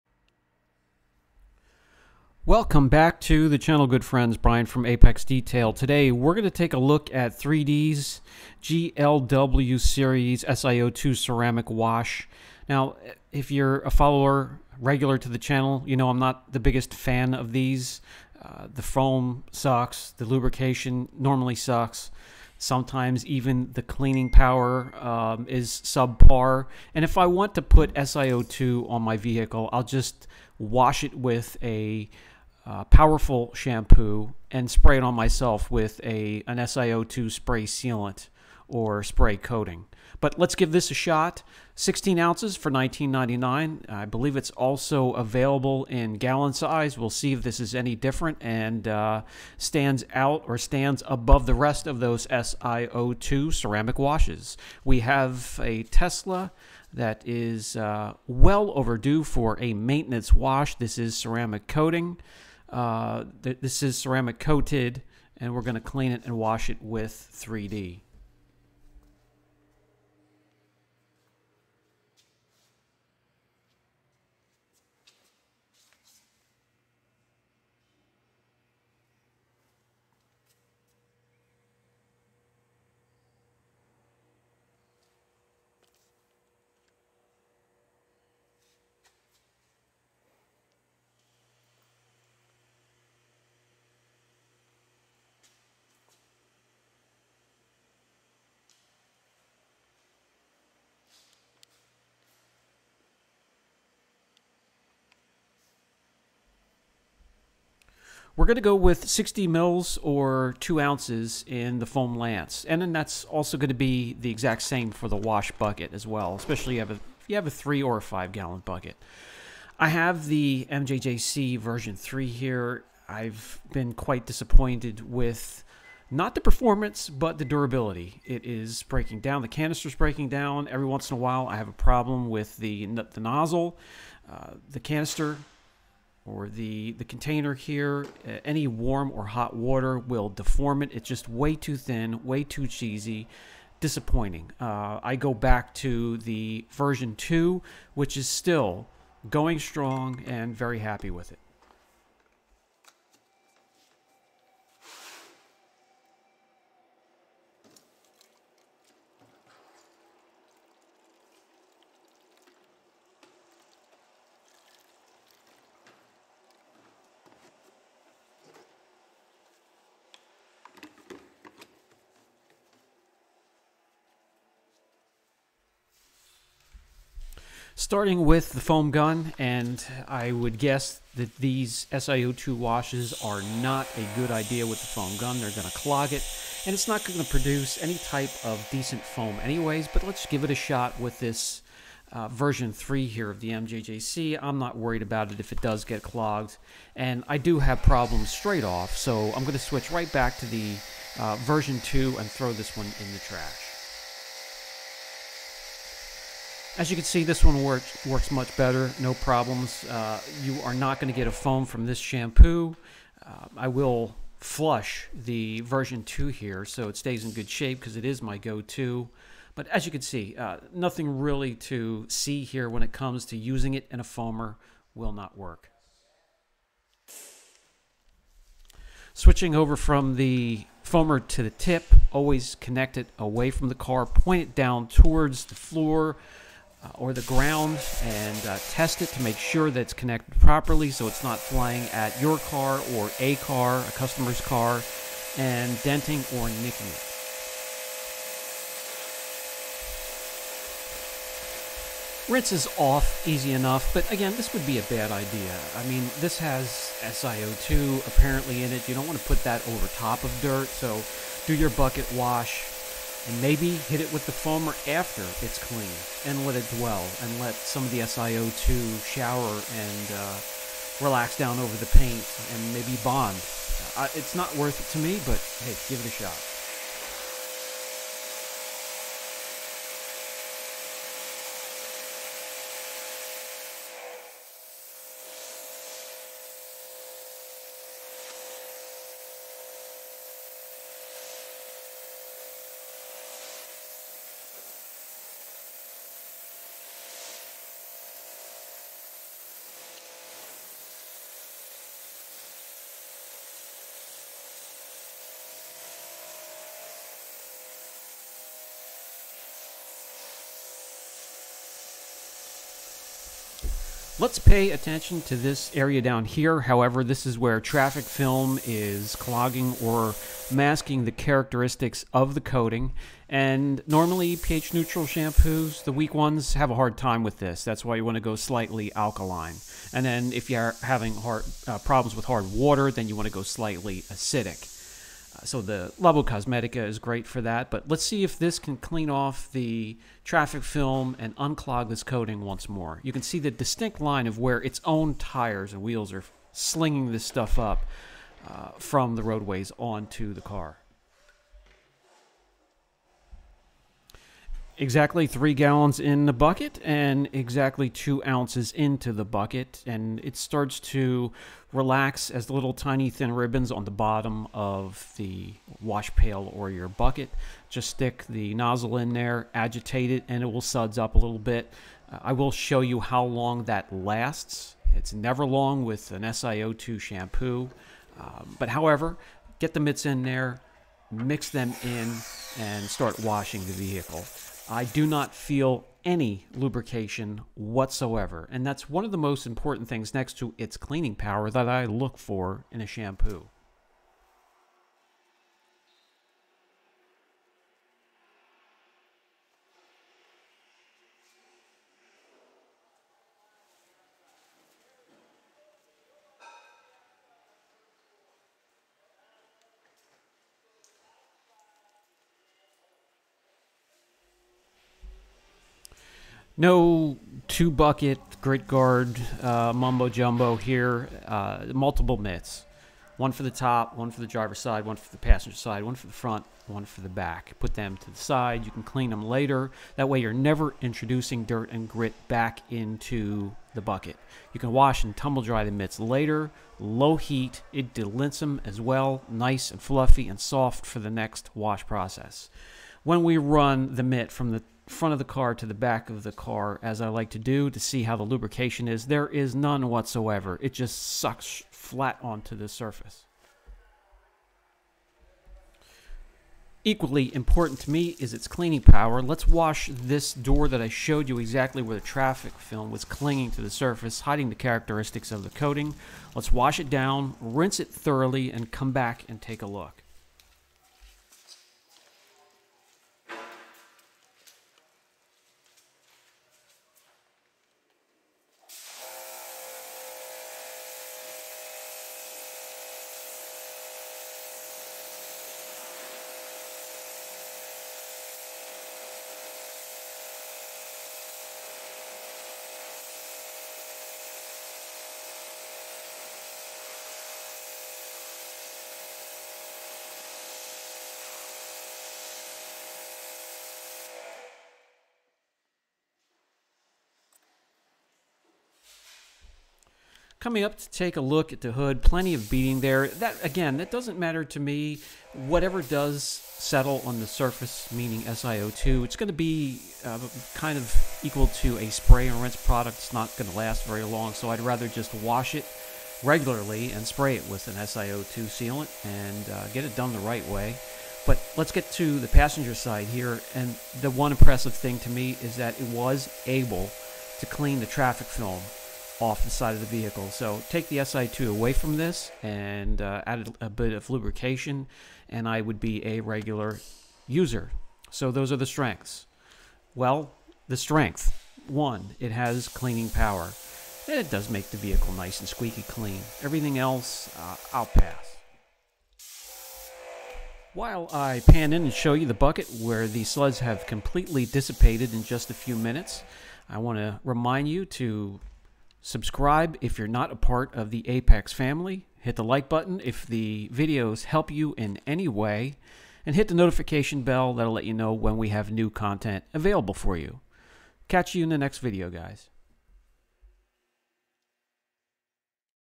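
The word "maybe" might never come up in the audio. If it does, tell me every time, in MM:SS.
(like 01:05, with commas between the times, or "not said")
04:23, 04:32.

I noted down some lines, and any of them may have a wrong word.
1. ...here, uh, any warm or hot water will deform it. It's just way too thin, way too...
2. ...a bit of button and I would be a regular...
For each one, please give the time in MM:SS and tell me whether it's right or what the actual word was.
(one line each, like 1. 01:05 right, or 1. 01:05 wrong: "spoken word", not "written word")
1. 02:17 right
2. 09:03 wrong: "lubrication", not "button".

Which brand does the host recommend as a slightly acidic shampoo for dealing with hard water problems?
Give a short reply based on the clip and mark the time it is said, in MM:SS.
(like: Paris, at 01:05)
Labo Cosmetica, at 05:35.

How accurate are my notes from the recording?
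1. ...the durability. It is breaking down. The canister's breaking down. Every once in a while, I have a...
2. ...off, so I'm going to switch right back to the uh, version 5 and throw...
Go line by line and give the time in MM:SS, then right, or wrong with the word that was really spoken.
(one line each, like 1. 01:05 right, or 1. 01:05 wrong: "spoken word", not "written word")
1. 02:07 right
2. 03:18 wrong: "2", not "5".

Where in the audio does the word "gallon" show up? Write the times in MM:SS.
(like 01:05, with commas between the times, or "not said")
00:46, 01:58, 05:55.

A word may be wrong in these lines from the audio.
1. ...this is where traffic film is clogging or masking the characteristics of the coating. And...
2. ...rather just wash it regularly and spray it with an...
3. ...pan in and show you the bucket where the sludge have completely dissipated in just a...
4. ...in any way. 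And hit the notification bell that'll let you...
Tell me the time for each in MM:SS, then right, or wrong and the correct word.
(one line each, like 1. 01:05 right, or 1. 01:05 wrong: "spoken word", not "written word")
1. 05:17 right
2. 08:44 right
3. 09:21 right
4. 09:34 right.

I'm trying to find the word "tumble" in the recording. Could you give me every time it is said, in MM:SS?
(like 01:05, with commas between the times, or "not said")
07:15.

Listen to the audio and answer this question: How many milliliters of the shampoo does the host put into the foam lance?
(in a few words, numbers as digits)
60.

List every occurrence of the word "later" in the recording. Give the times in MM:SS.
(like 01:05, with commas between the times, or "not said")
07:09, 07:15.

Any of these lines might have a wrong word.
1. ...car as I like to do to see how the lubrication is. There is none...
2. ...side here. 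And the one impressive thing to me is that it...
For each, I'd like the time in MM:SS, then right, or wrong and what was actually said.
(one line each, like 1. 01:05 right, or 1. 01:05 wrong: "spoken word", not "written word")
1. 07:26 right
2. 08:52 right.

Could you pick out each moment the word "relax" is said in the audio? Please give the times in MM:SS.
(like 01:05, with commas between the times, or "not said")
04:31, 06:01.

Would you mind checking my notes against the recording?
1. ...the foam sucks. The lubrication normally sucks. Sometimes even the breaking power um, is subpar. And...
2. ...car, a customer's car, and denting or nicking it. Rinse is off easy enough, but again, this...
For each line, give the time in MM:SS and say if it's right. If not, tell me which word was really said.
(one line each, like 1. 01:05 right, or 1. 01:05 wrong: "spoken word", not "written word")
1. 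00:18 wrong: "cleaning", not "breaking"
2. 04:03 right.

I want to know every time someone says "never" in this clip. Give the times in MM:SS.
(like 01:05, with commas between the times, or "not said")
06:15, 07:10.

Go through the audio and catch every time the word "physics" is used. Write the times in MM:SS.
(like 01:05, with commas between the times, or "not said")
not said.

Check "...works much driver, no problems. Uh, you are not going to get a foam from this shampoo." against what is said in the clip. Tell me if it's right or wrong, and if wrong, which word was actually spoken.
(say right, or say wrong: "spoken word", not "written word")
wrong: "better", not "driver".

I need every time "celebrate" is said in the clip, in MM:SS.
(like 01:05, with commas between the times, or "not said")
not said.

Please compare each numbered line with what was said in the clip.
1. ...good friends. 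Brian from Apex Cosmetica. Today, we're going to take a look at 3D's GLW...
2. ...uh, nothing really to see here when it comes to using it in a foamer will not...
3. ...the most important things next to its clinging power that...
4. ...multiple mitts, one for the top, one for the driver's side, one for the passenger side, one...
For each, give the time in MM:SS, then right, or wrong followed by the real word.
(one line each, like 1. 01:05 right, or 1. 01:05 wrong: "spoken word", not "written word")
1. 00:03 wrong: "Detail", not "Cosmetica"
2. 03:40 right
3. 06:29 wrong: "cleaning", not "clinging"
4. 07:01 right.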